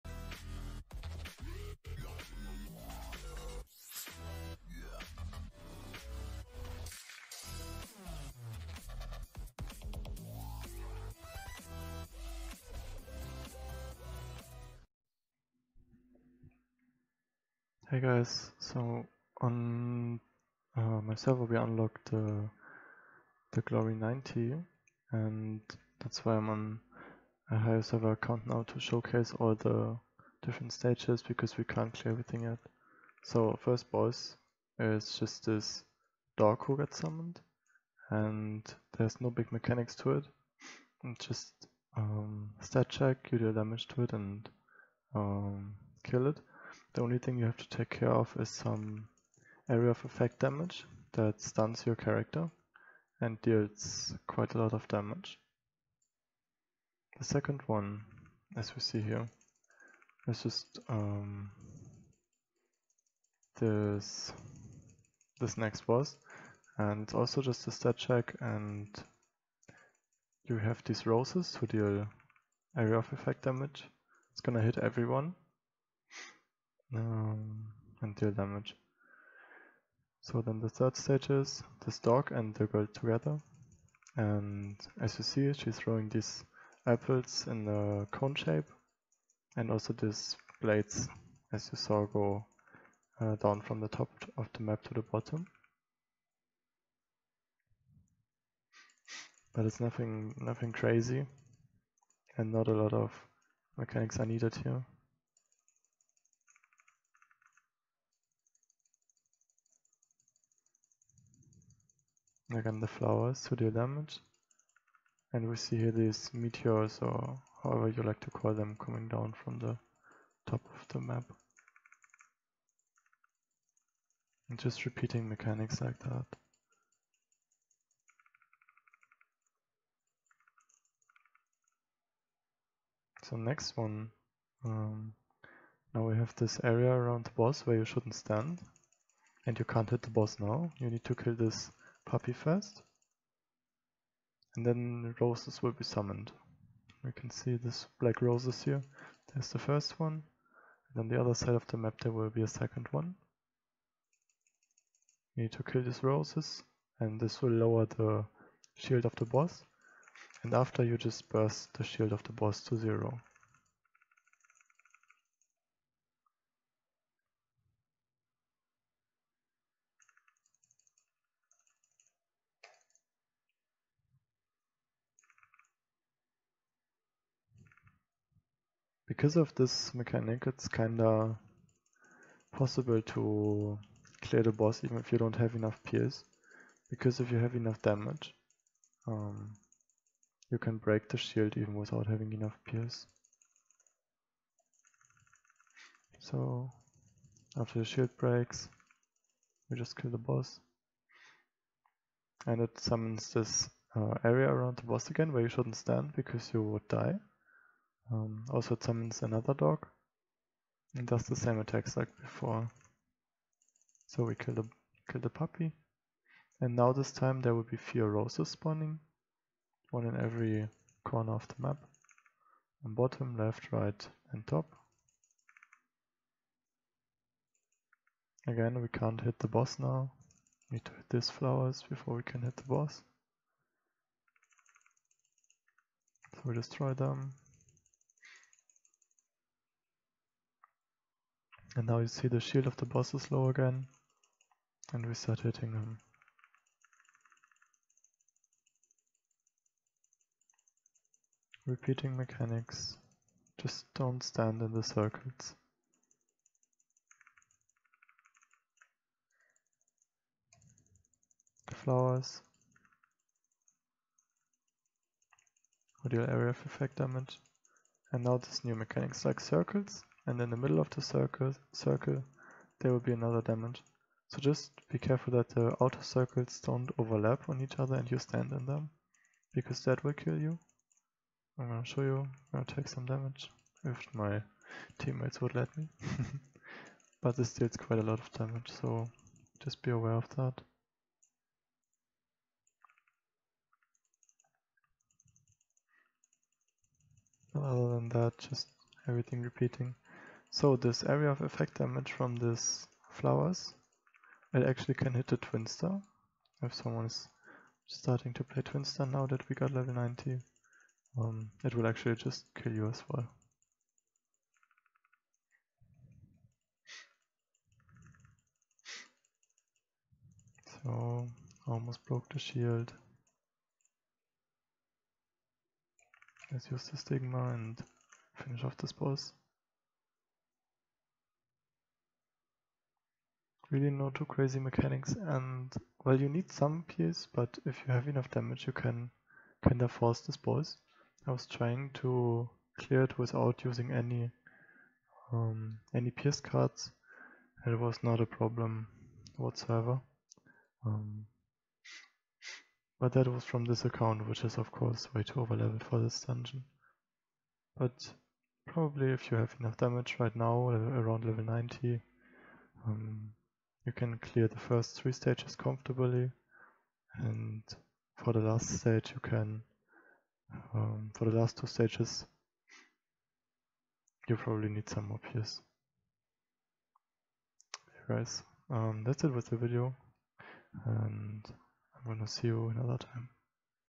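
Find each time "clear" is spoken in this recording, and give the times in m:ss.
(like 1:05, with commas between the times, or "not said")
0:31, 3:04, 5:42, 6:04.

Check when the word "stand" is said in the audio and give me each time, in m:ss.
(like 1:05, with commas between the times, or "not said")
2:18, 3:25, 4:14, 4:38.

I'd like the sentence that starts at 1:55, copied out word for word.
And we see here these meteors or however you like to call them coming down from the top of the map.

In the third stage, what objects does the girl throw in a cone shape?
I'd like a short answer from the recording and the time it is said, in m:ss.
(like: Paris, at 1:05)
apples, at 1:26.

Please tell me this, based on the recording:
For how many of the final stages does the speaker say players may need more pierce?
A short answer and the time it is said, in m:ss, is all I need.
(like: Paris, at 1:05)
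2, at 6:11.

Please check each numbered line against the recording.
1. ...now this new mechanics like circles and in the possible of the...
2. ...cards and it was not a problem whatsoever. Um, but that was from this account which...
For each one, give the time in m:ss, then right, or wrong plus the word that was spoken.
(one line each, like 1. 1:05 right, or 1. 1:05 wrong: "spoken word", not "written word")
1. 4:28 wrong: "middle", not "possible"
2. 5:46 right.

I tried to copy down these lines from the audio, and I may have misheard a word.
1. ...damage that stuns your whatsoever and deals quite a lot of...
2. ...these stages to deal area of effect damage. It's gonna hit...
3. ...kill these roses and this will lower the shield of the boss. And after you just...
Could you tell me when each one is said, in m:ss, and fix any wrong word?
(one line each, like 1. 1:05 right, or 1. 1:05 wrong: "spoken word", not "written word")
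1. 0:50 wrong: "character", not "whatsoever"
2. 1:10 wrong: "roses", not "stages"
3. 2:35 right.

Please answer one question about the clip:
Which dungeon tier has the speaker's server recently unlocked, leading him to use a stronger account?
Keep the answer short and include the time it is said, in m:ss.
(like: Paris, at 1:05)
Glory 90, at 0:23.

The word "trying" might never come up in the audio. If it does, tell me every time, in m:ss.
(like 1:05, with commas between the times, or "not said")
5:41.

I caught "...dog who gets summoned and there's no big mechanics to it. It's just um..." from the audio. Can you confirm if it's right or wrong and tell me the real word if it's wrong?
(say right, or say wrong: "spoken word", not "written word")
right.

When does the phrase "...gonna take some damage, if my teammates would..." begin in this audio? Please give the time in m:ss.
4:42.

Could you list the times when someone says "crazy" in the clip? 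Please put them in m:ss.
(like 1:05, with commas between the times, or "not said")
1:40, 5:34.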